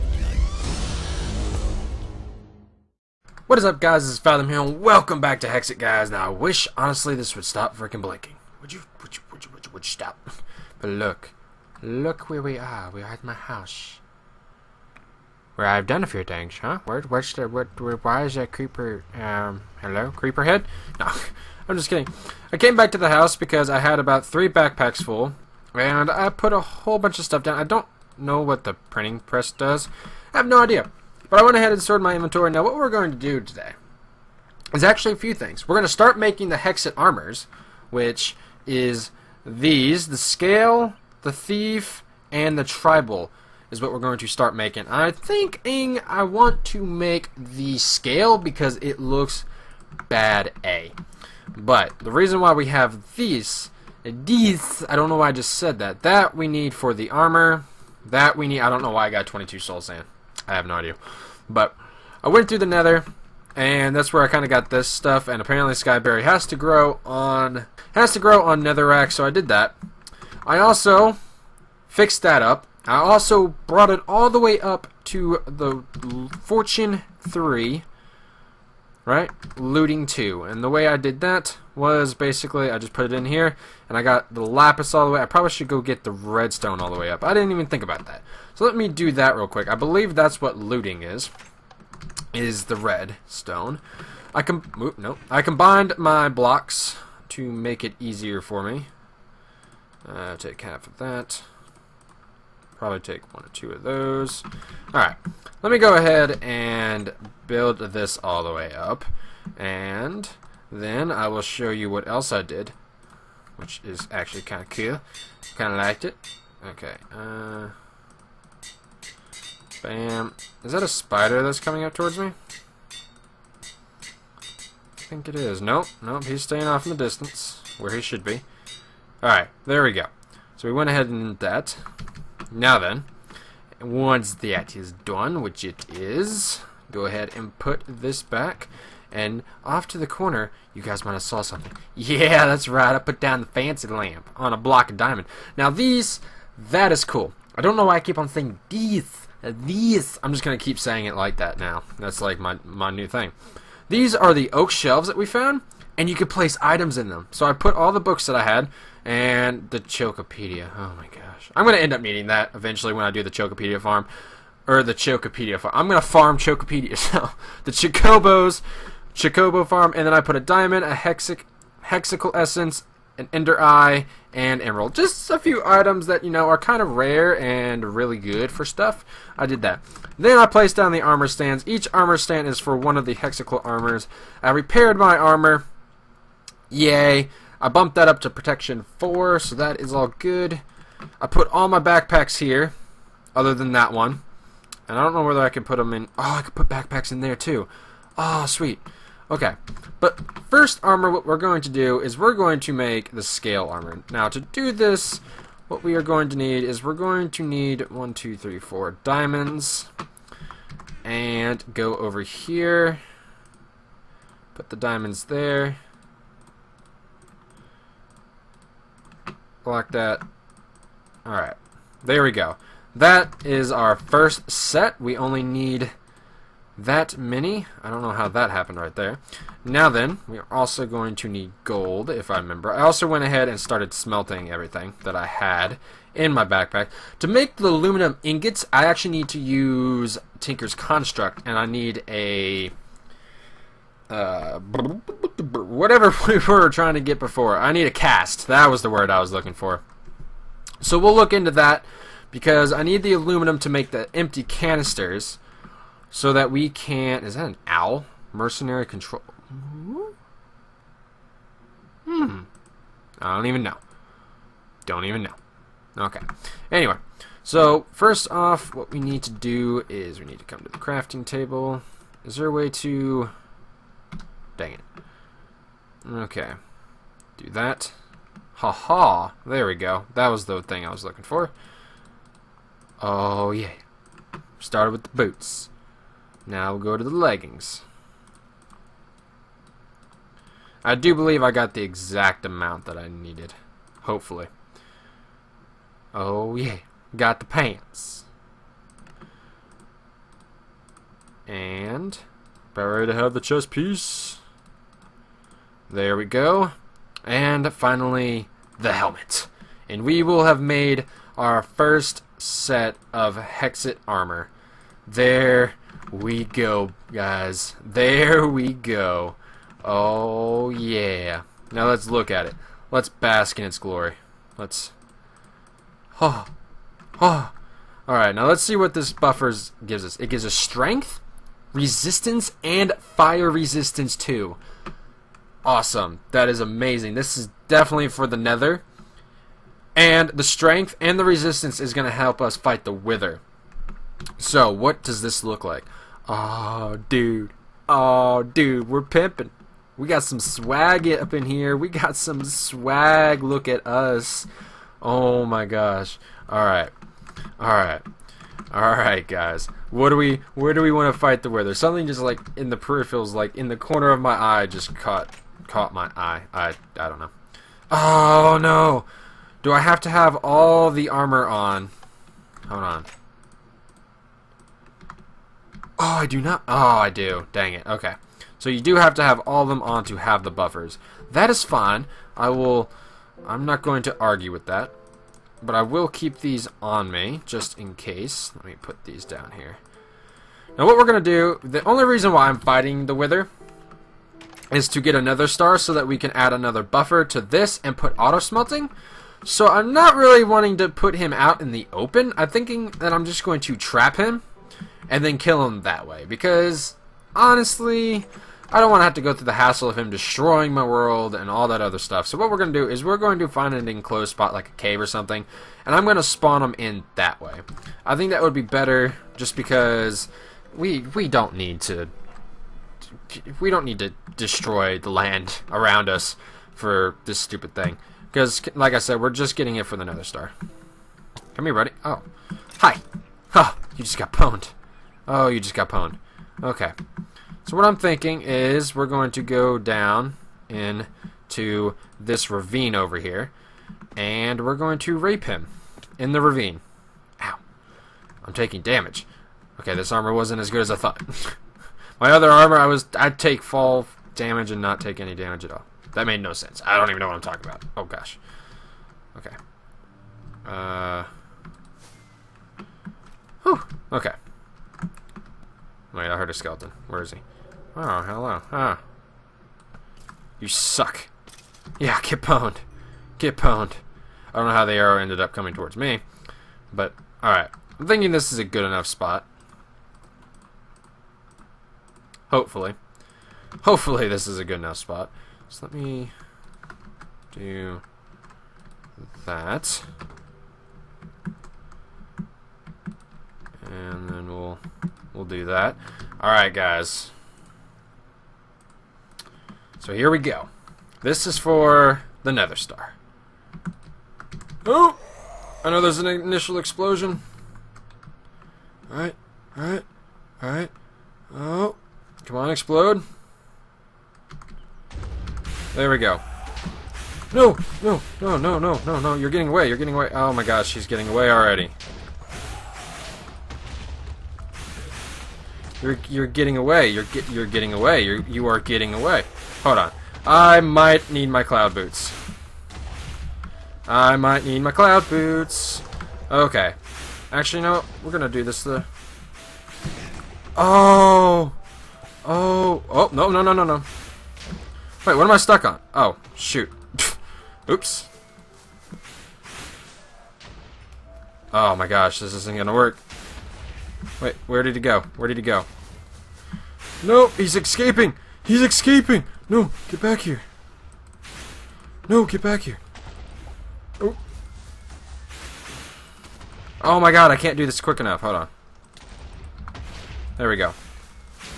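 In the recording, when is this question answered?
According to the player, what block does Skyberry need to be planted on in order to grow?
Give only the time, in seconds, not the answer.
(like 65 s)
68 s.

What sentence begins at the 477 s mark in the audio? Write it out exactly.
I'm thinking this is a good enough spot.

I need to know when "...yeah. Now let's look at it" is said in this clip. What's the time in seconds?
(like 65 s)
320 s.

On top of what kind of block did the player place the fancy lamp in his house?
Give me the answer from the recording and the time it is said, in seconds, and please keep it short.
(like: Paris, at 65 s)
Block of diamond, at 144 s.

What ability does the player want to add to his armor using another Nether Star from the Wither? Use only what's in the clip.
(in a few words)
Auto smelting.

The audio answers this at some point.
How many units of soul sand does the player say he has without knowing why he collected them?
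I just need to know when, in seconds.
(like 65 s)
59 s.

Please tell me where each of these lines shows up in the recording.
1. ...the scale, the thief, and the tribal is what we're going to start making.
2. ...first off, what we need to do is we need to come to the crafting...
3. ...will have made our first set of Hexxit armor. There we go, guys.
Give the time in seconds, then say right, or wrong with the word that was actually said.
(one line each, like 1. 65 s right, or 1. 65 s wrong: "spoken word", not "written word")
1. 40 s right
2. 267 s right
3. 310 s right.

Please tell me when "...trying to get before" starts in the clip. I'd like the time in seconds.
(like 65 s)
246 s.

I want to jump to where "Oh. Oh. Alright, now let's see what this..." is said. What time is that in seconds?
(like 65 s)
326 s.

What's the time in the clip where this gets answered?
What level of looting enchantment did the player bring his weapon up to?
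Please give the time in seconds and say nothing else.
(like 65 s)
79 s.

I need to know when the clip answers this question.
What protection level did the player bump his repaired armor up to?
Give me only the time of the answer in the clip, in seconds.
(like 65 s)
188 s.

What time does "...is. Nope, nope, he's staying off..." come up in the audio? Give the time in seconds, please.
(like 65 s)
125 s.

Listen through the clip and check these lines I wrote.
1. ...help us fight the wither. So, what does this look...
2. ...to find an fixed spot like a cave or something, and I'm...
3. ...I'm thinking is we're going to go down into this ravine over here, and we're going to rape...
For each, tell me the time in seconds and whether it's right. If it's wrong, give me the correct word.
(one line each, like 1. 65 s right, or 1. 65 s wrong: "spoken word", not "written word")
1. 342 s right
2. 413 s wrong: "enclosed", not "fixed"
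3. 437 s right.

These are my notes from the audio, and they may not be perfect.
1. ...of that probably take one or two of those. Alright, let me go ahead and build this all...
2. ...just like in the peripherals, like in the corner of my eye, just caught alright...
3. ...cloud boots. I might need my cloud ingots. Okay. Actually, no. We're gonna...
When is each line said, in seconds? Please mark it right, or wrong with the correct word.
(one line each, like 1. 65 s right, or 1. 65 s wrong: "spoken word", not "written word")
1. 100 s right
2. 362 s wrong: "caught", not "alright"
3. 531 s wrong: "boots", not "ingots".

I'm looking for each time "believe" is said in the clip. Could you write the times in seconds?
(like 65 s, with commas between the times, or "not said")
89 s, 291 s.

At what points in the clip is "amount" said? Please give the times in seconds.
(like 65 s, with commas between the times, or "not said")
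292 s.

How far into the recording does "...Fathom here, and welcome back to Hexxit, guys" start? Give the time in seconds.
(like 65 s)
4 s.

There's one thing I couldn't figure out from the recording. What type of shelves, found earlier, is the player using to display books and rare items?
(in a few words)
Oak shelves.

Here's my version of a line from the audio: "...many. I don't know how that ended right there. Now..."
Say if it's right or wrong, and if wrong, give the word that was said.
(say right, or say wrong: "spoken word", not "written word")
wrong: "happened", not "ended".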